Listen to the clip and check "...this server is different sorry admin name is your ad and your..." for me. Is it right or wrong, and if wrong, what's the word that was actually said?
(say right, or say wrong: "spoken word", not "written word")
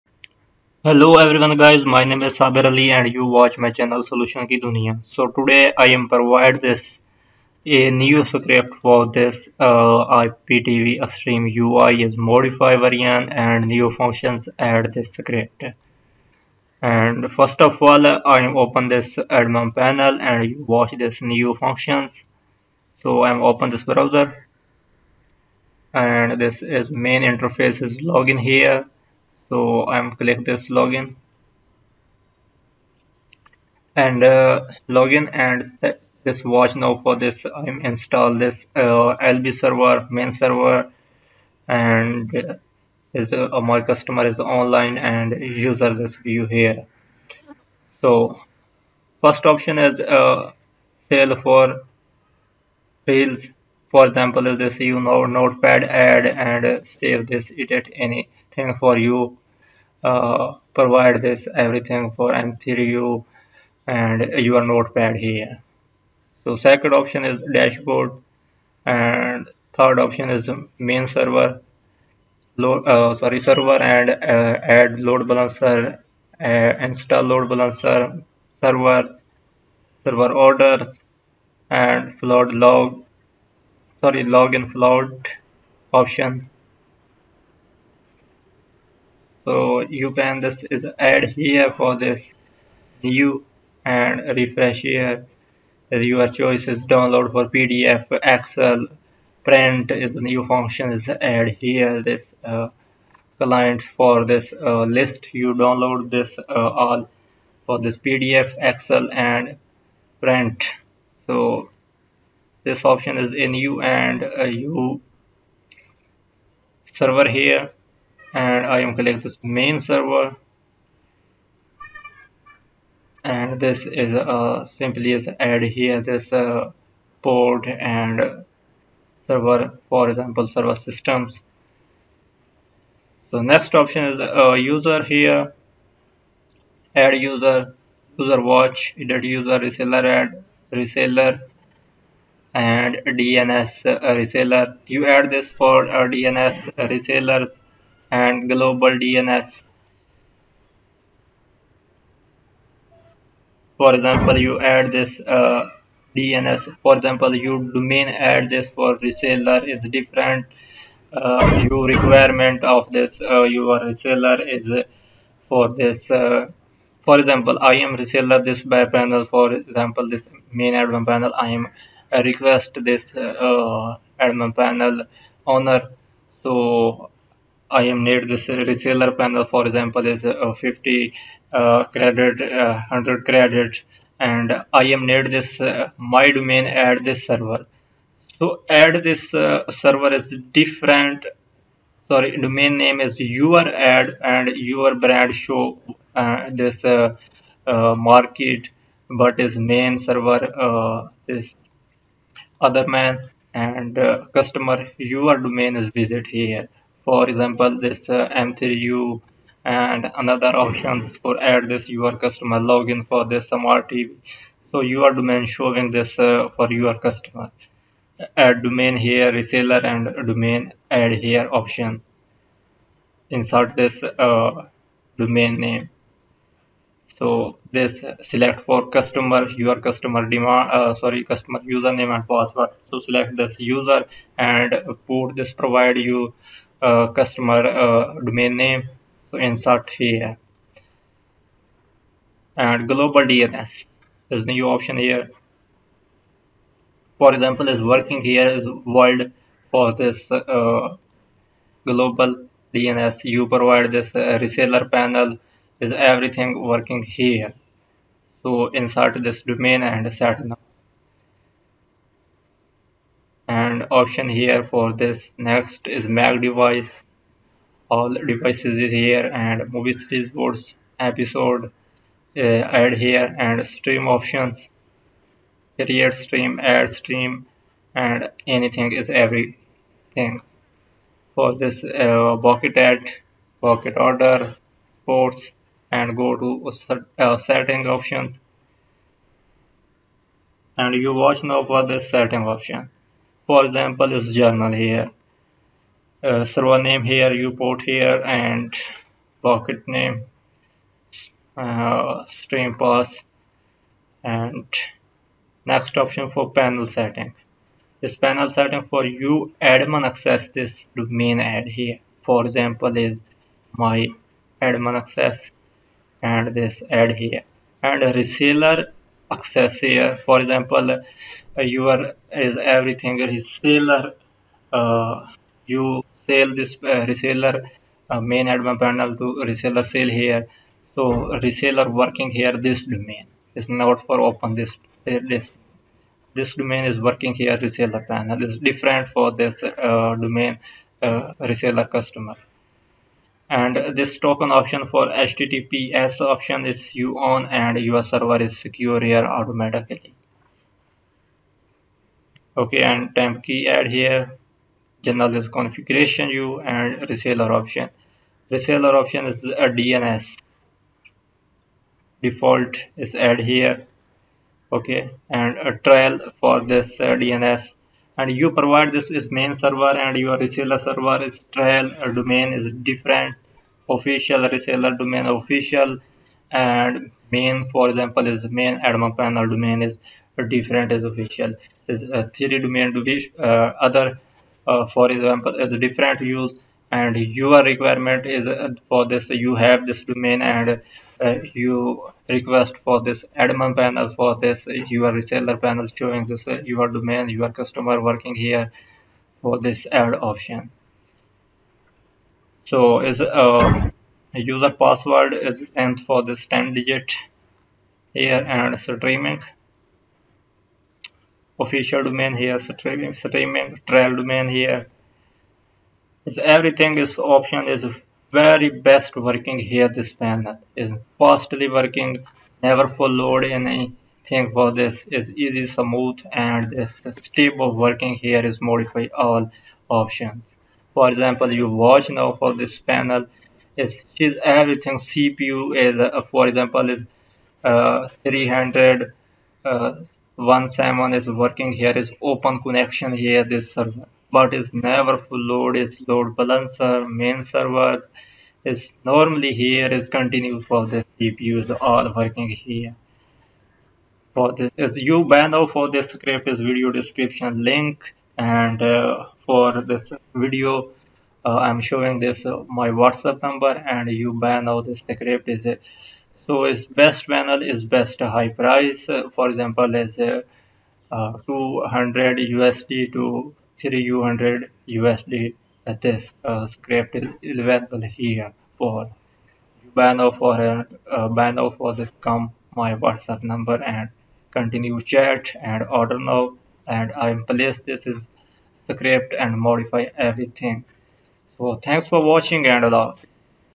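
wrong: "domain", not "admin".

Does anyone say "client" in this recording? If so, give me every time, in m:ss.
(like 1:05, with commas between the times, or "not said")
1:43.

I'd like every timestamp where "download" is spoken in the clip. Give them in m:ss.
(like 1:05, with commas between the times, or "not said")
1:36, 1:45.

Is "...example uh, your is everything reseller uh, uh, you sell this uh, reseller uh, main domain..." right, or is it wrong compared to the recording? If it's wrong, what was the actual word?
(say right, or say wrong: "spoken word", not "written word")
wrong: "admin", not "domain".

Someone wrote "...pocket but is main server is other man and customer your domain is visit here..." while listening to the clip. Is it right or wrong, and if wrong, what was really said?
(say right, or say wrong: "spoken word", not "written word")
wrong: "market", not "pocket".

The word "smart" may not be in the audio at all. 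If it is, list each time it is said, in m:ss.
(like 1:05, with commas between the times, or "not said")
3:33.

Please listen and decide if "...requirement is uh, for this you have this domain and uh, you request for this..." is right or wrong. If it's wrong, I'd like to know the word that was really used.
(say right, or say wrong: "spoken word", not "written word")
right.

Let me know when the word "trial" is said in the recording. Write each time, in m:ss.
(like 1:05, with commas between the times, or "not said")
6:05, 6:11, 6:53.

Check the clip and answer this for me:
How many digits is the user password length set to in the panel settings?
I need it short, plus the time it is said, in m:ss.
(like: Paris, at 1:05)
10, at 6:46.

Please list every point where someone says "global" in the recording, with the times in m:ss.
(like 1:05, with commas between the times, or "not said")
2:28, 4:02, 4:11.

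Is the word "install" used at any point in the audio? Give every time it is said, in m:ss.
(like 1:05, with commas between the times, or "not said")
0:37, 1:16.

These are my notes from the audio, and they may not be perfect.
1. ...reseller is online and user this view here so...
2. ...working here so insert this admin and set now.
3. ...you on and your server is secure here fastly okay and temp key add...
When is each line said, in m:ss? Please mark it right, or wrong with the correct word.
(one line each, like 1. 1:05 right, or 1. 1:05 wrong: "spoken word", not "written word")
1. 0:43 wrong: "customer", not "reseller"
2. 4:16 wrong: "domain", not "admin"
3. 5:46 wrong: "automatically", not "fastly".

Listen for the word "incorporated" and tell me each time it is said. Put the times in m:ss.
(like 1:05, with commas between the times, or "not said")
not said.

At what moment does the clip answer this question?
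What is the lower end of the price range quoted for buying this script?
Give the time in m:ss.
7:51.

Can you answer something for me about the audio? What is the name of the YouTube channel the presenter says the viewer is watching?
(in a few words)
Solution ki dunya.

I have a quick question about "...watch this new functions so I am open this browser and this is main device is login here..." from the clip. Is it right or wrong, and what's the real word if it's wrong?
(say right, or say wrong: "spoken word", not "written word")
wrong: "interface", not "device".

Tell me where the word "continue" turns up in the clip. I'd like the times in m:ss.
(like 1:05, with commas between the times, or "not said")
7:30, 8:04.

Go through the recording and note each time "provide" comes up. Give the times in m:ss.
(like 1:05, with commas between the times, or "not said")
0:06, 1:00, 3:55, 4:13, 6:08.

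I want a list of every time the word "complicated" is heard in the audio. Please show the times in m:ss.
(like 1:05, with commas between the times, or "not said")
not said.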